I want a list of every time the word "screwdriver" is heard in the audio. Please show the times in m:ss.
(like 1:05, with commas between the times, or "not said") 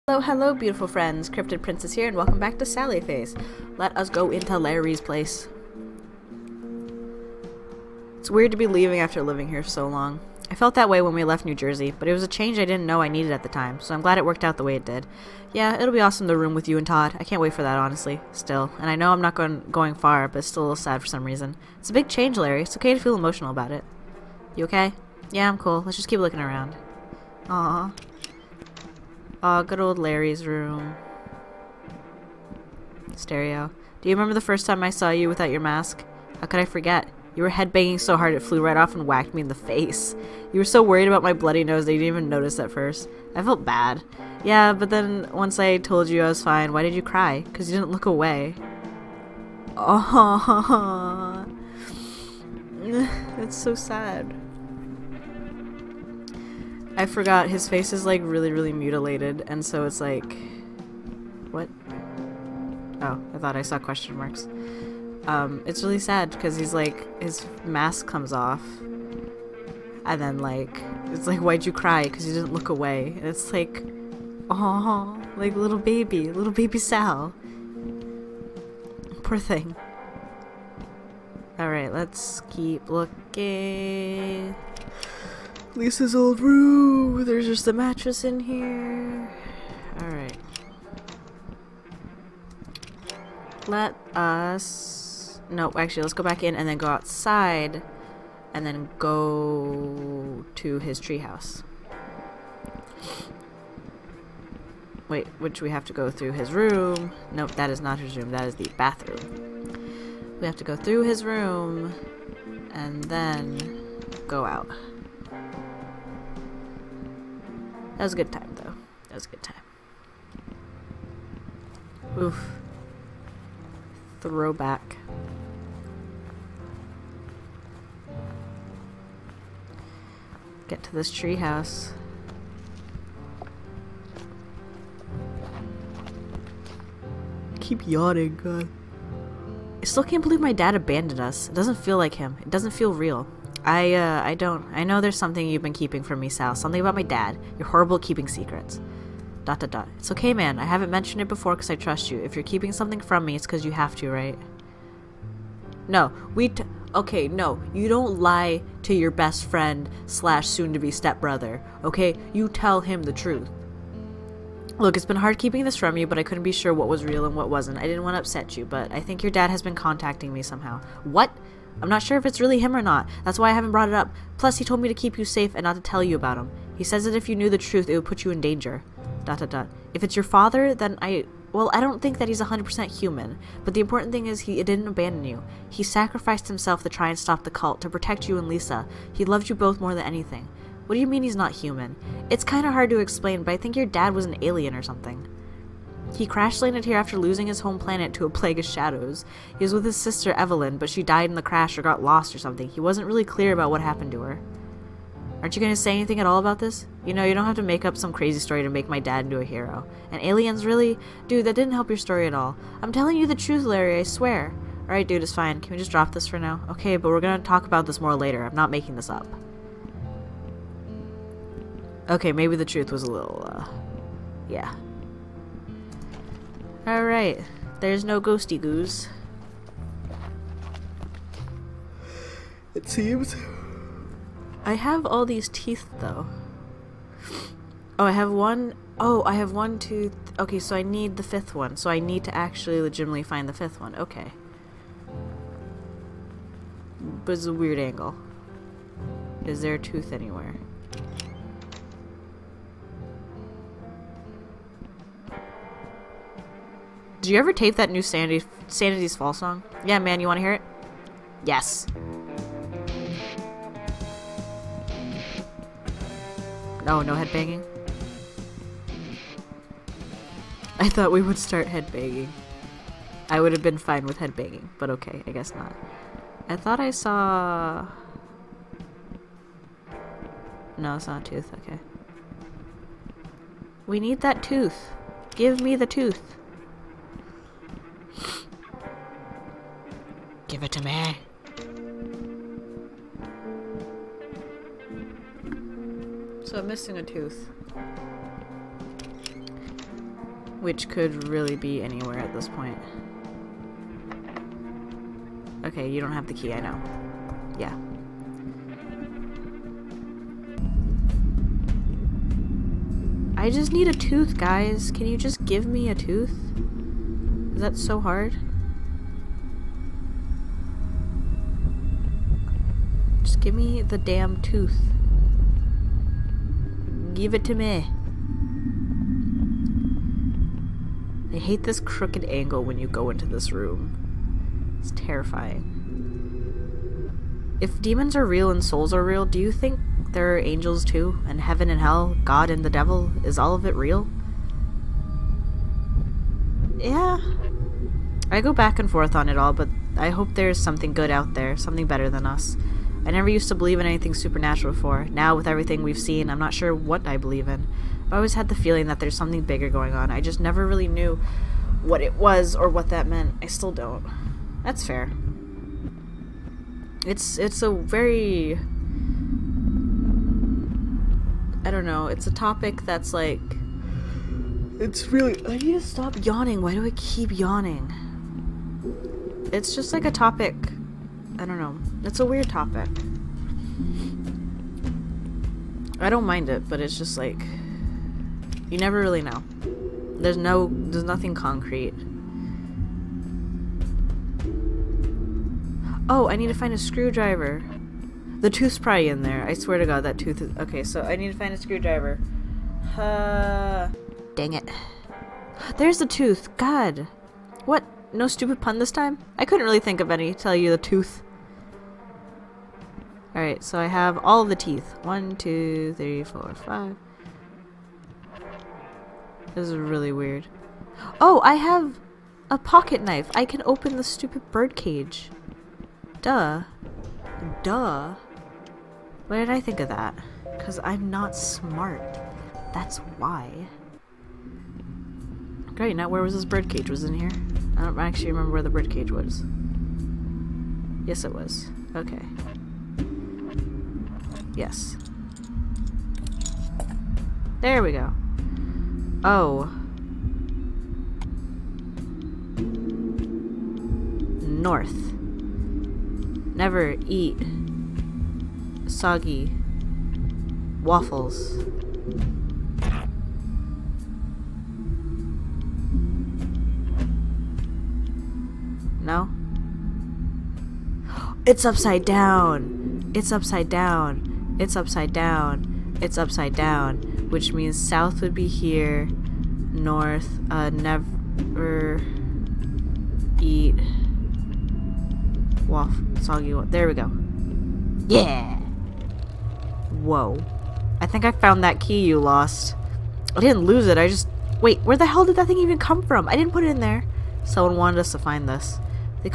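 6:36, 6:41.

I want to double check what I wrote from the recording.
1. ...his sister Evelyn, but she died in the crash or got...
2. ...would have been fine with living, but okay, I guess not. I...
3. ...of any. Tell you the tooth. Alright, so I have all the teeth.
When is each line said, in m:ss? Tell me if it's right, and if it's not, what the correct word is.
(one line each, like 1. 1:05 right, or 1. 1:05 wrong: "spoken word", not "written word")
1. 3:19 right
2. 4:33 wrong: "headbanging", not "living"
3. 6:49 right.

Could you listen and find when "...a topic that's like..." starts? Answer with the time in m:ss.
6:12.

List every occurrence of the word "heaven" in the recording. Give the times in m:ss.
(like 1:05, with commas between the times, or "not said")
5:41.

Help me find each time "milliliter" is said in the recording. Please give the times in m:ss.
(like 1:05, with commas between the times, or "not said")
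not said.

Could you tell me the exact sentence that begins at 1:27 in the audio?
There's just a mattress in here.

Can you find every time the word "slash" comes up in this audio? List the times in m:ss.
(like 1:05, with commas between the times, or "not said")
2:40.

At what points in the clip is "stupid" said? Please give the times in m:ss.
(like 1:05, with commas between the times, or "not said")
6:48, 7:04.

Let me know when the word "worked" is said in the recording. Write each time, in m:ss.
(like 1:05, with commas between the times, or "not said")
0:14.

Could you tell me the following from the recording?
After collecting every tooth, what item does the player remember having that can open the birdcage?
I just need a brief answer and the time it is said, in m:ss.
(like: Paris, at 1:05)
A pocket knife, at 7:02.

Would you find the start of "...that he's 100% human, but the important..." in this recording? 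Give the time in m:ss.
3:02.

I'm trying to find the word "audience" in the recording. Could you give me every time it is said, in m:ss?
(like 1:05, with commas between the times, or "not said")
not said.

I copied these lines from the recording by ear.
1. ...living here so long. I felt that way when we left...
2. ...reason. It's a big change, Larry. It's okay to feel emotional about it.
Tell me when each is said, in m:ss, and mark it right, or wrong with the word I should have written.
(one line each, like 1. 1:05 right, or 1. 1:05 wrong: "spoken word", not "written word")
1. 0:09 right
2. 0:21 right.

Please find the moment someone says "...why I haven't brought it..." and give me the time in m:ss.
2:53.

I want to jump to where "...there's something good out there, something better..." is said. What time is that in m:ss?
5:50.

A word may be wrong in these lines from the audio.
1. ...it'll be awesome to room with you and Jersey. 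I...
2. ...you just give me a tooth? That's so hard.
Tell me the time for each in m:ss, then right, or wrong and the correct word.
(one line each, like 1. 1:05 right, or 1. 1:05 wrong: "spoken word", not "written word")
1. 0:15 wrong: "Todd", not "Jersey"
2. 5:15 right.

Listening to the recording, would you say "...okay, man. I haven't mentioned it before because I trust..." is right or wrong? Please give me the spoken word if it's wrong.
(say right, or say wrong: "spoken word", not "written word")
right.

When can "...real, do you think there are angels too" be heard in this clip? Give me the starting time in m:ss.
5:39.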